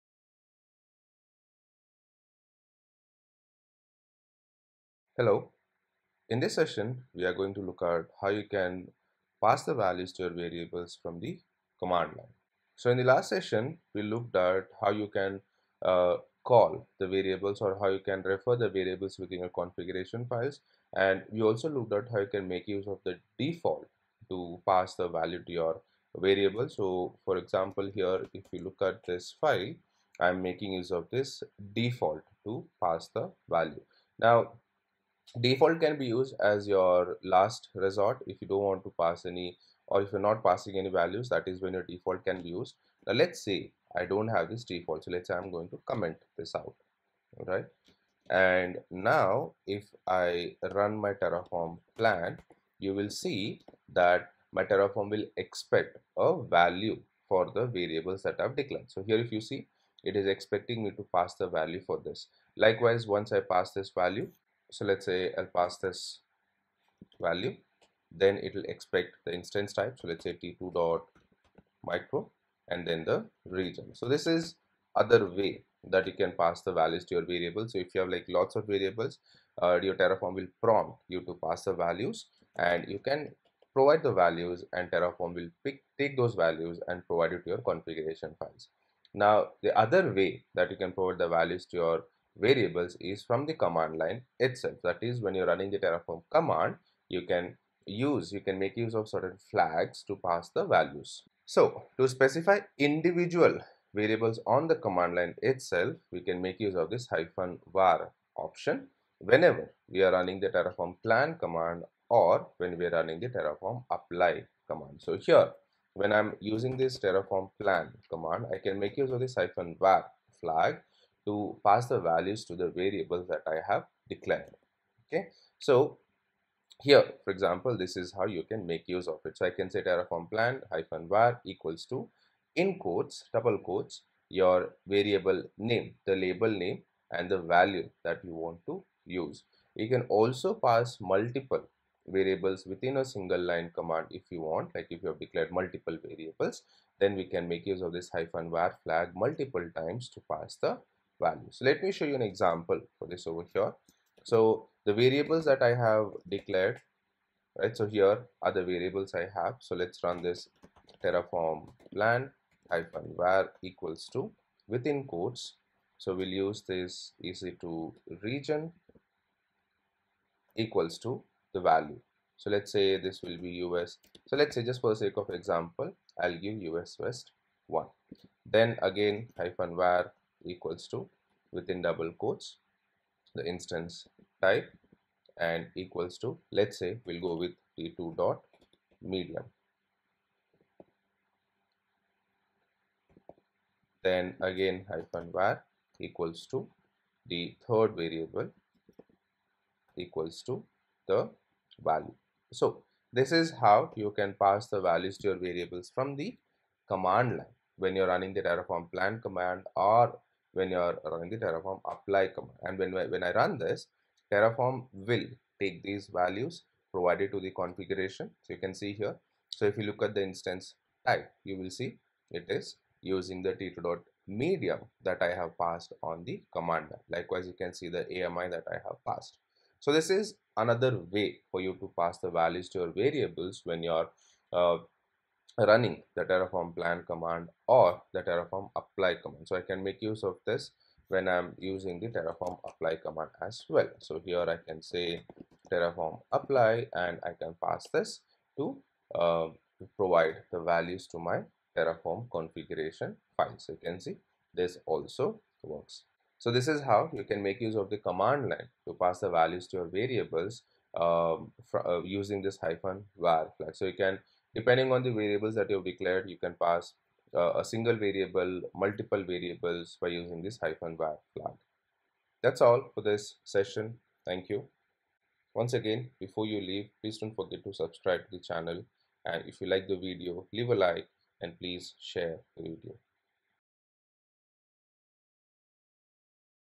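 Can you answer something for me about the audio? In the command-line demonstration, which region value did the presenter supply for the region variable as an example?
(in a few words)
us-west-1.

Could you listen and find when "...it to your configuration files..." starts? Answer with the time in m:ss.
1:27.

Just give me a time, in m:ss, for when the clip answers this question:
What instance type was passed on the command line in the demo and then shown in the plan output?
3:07.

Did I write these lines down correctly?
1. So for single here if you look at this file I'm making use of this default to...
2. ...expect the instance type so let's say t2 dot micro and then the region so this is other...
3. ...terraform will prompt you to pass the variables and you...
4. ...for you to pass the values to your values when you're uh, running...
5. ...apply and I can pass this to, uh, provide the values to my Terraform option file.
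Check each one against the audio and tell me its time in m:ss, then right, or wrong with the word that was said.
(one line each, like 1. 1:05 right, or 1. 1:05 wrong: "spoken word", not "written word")
1. 0:26 wrong: "example", not "single"
2. 1:08 right
3. 1:19 wrong: "values", not "variables"
4. 3:51 wrong: "variables", not "values"
5. 4:06 wrong: "configuration", not "option".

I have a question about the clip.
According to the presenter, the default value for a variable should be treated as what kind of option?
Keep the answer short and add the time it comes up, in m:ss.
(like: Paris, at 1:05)
last resort, at 0:37.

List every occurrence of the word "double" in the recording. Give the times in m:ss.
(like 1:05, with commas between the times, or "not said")
2:13, 3:01.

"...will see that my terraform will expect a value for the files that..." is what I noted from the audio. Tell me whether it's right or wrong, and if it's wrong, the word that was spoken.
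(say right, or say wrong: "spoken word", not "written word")
wrong: "variables", not "files".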